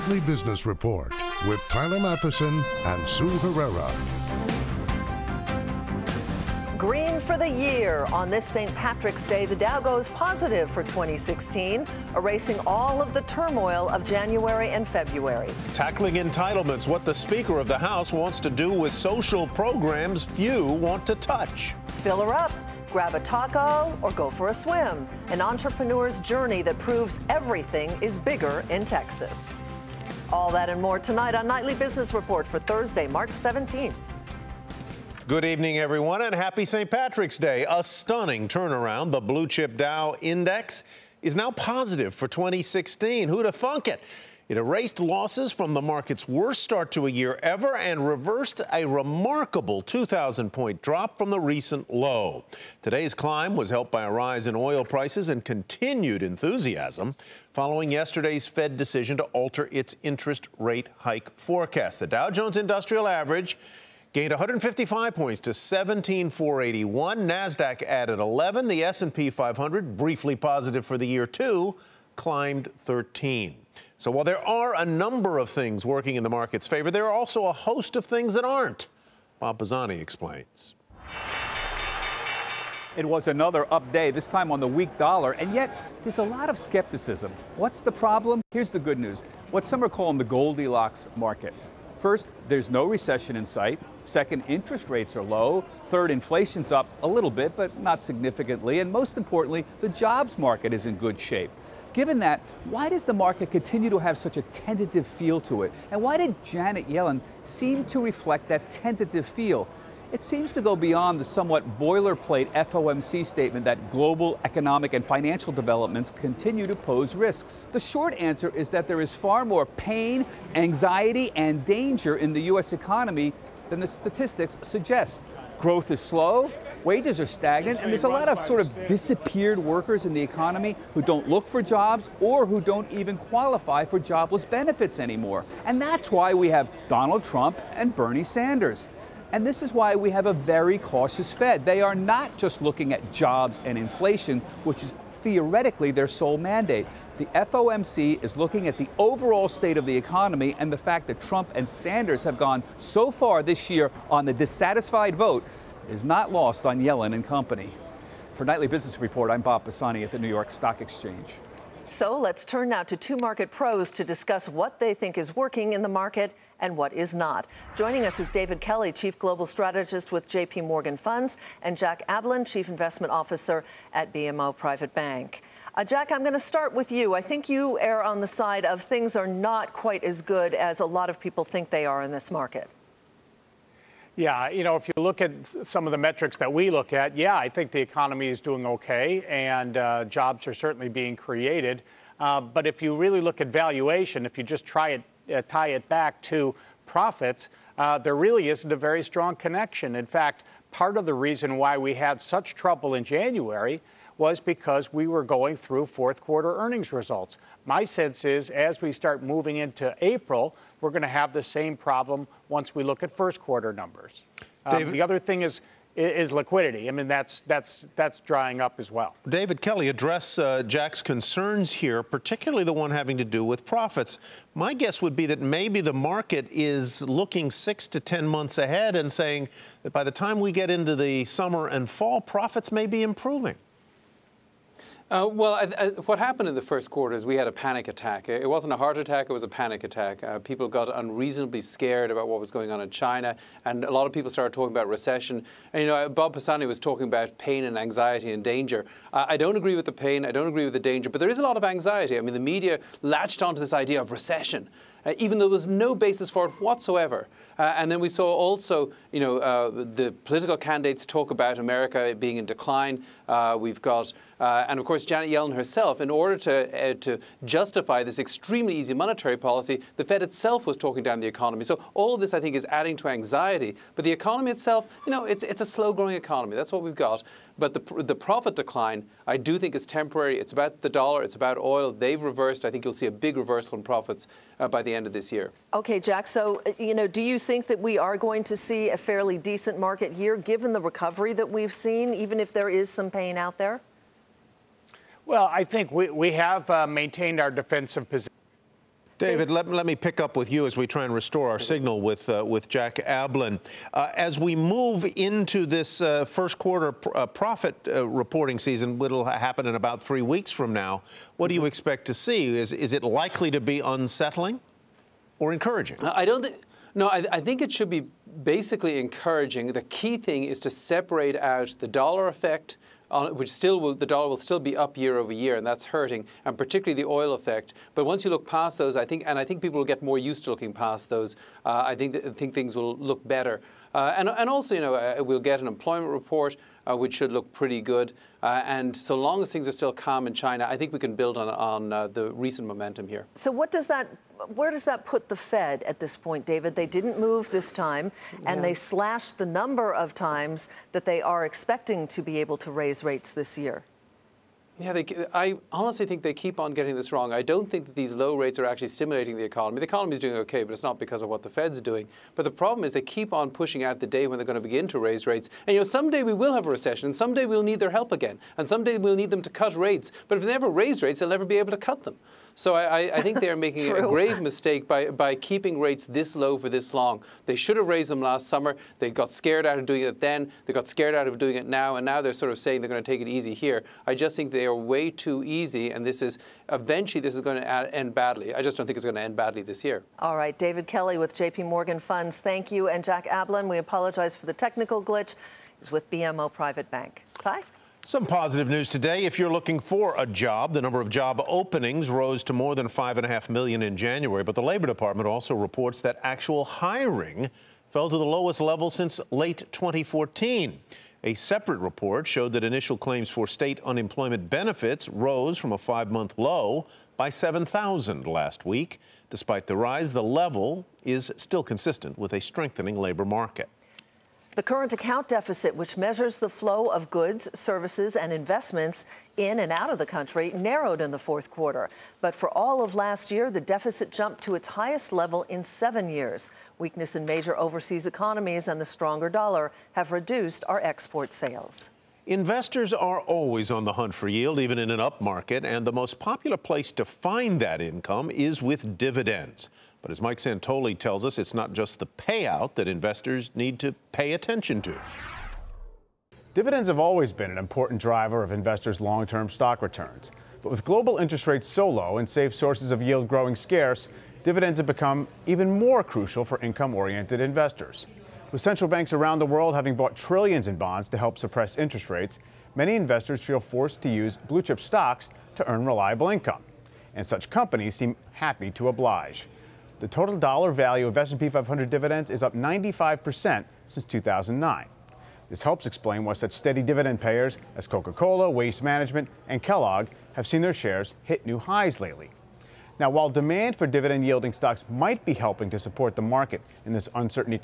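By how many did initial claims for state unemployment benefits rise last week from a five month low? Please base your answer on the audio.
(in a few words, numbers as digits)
7,000.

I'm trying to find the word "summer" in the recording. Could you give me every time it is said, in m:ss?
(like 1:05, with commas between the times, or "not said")
3:51, 6:18.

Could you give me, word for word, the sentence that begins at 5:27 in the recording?
But once you look past those, I think, and I think people will get more used to looking past those.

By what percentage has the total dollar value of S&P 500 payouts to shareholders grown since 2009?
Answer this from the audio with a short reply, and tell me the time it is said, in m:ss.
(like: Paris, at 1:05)
95%, at 8:02.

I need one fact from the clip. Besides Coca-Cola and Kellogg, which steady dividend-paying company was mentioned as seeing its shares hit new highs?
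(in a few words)
Waste Management.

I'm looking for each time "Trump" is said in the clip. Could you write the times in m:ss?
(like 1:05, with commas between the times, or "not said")
2:17, 2:31.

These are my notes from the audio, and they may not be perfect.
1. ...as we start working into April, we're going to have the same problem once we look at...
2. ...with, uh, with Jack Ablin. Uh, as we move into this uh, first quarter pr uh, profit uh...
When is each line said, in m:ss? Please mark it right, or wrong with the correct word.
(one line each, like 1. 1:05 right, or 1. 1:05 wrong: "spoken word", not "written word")
1. 3:28 wrong: "moving", not "working"
2. 5:02 right.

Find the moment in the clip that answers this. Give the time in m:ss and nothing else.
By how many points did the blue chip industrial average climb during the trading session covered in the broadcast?
1:04.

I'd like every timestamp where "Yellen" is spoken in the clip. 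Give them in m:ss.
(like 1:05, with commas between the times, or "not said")
1:46, 2:36, 4:25.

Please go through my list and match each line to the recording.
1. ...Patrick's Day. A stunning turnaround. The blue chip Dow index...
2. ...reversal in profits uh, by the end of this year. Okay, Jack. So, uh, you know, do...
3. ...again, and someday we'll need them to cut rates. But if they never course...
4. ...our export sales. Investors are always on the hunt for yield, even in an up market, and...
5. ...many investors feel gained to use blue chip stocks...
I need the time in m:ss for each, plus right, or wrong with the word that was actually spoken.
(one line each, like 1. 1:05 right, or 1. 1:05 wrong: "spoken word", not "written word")
1. 0:36 right
2. 4:43 right
3. 6:08 wrong: "raise", not "course"
4. 7:20 right
5. 7:52 wrong: "forced", not "gained".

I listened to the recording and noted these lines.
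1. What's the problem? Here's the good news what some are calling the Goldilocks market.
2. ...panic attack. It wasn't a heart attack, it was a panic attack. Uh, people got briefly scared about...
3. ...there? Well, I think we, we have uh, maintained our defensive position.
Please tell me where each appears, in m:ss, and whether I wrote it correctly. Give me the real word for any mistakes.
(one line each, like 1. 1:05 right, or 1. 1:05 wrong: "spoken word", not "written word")
1. 1:27 right
2. 3:57 wrong: "unreasonably", not "briefly"
3. 4:53 right.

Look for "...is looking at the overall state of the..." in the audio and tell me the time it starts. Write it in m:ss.
2:28.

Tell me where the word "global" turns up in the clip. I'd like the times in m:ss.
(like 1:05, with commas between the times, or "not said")
1:53, 2:49, 7:40.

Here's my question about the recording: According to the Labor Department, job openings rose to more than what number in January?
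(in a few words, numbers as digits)
5.5 million.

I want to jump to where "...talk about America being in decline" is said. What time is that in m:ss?
4:21.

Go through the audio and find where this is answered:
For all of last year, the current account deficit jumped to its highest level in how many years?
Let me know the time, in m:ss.
7:15.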